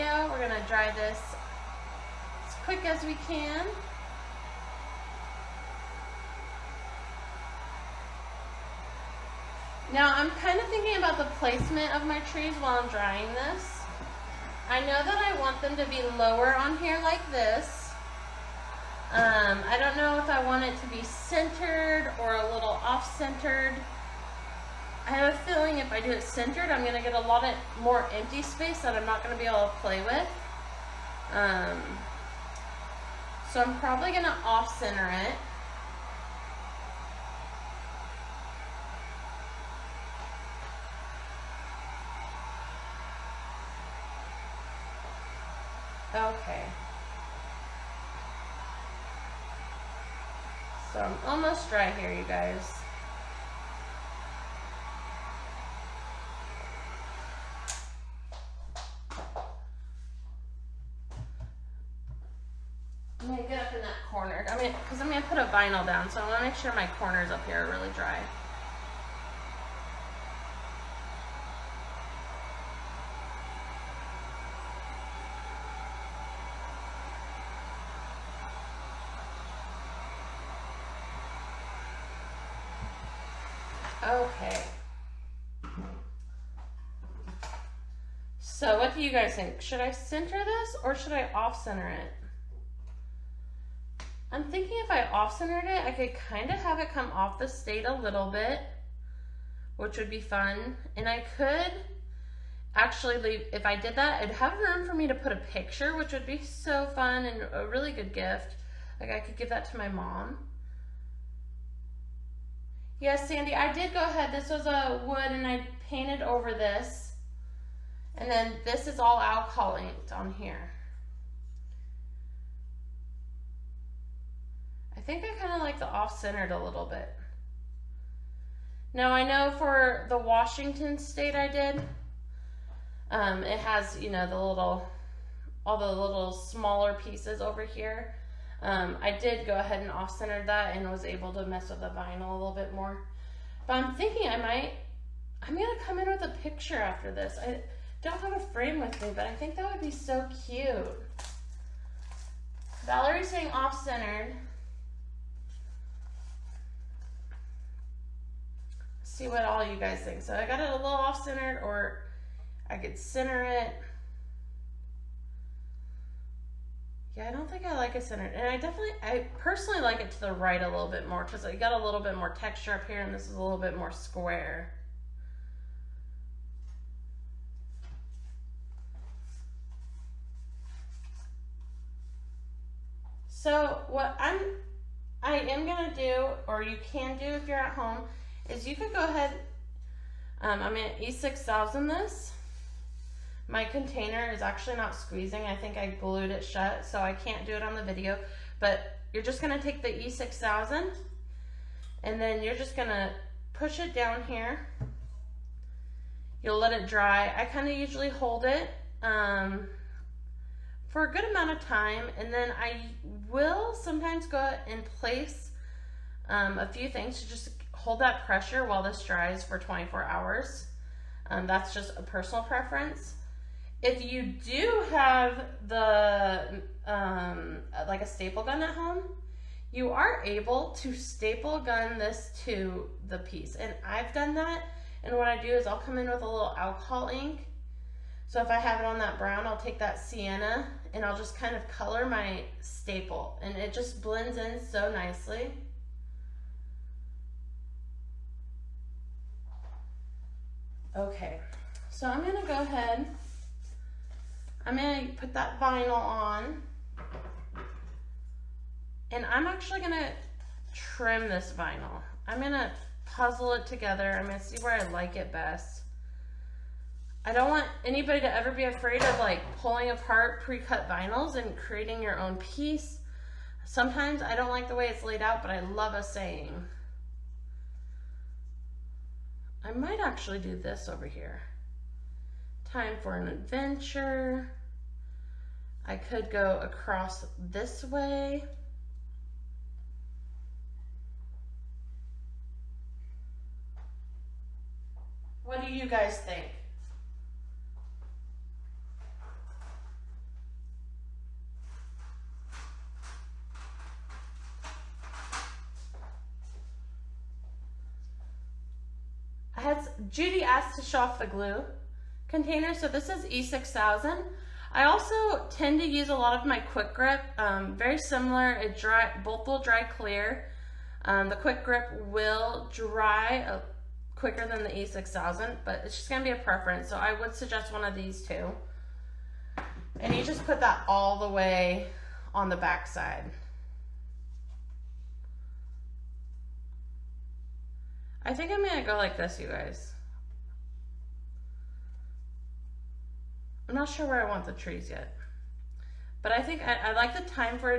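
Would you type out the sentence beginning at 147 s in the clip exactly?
I, don't have a frame with me, but I think that would be so cute.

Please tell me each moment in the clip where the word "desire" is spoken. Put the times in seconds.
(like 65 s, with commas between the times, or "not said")
not said.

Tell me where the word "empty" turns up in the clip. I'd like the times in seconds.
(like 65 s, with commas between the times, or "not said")
28 s.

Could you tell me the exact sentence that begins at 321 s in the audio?
Um, the quick grip will dry uh, quicker than the E6000, but it's just gonna be a preference.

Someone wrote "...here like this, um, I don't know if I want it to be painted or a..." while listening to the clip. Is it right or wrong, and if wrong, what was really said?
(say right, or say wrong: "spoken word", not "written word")
wrong: "centered", not "painted".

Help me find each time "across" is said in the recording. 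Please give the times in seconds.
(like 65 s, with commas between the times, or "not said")
286 s.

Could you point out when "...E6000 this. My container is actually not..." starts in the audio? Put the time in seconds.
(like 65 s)
190 s.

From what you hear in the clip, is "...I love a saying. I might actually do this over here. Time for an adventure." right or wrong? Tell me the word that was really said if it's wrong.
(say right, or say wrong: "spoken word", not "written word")
right.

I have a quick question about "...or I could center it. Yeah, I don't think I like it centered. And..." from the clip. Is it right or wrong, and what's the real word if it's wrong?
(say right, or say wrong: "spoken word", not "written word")
right.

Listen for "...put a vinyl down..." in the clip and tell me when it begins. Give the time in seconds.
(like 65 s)
65 s.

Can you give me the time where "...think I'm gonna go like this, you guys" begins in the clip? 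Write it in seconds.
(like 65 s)
338 s.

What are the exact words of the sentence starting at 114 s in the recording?
This was a wood and I painted over this.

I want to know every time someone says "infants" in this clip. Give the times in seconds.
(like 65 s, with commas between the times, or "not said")
not said.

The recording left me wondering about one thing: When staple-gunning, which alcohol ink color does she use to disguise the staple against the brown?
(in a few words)
sienna.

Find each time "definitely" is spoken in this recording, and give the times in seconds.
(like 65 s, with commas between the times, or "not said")
168 s.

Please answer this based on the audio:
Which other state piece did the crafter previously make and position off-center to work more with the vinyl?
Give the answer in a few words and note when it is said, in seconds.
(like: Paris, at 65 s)
Washington, at 130 s.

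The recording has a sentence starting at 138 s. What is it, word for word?
Um, I did go ahead and off-centered that and was able to mess with the vinyl a little bit more.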